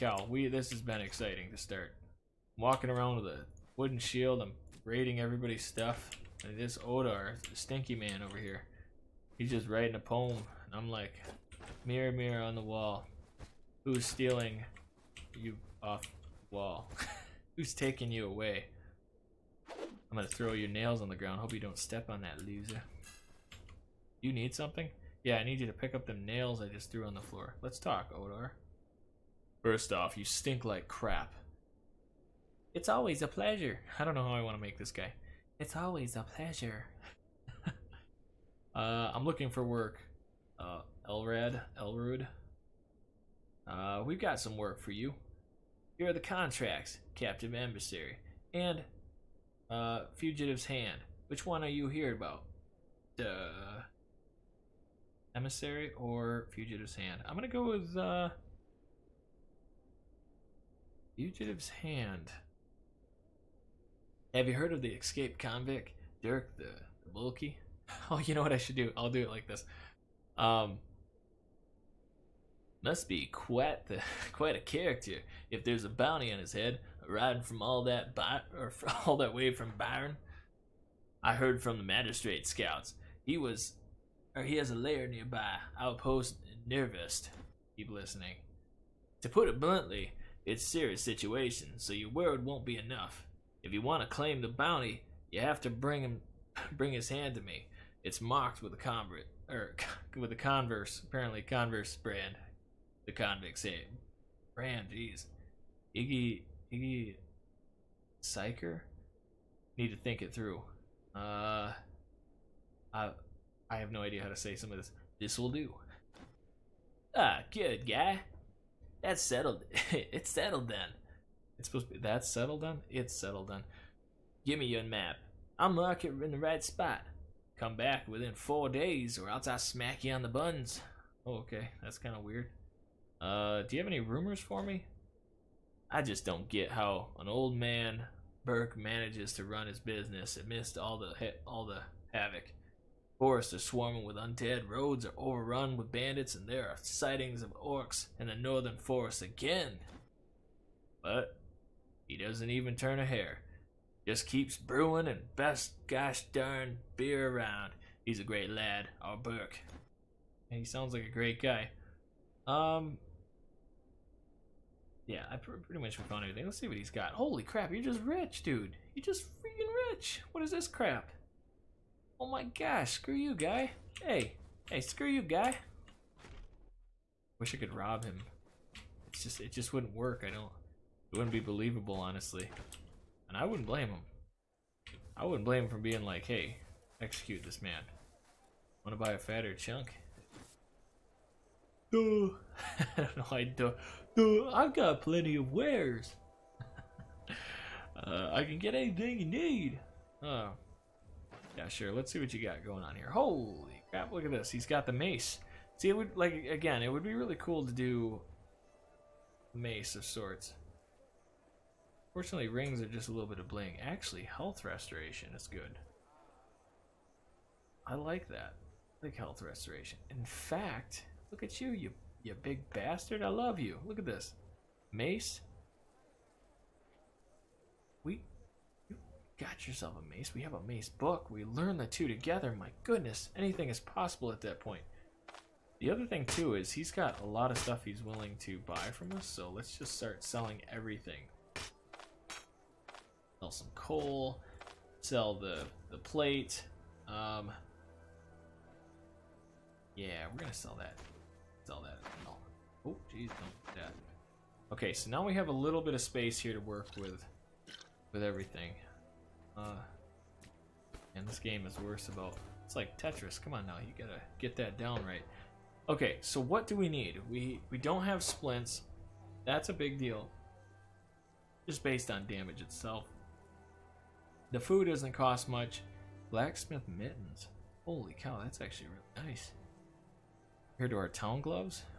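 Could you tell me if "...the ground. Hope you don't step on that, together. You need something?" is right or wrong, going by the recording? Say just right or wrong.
wrong.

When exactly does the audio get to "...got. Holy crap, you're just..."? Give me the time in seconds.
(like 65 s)
166 s.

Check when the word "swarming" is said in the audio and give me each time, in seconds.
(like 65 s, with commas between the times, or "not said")
143 s.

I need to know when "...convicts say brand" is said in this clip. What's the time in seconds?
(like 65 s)
103 s.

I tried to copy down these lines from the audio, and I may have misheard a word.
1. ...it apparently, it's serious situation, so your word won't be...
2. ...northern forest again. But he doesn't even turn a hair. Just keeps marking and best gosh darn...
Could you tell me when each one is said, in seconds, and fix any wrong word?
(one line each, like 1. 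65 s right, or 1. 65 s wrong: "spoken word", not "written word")
1. 89 s wrong: "bluntly", not "apparently"
2. 148 s wrong: "brewing", not "marking".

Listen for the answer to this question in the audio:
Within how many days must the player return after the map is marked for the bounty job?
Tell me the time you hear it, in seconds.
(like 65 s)
128 s.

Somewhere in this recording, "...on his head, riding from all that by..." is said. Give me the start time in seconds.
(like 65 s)
76 s.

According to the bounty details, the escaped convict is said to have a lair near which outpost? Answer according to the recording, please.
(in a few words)
Outpost Nervist.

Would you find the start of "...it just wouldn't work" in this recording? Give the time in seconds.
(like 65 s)
179 s.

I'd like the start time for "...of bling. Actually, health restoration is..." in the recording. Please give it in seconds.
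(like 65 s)
213 s.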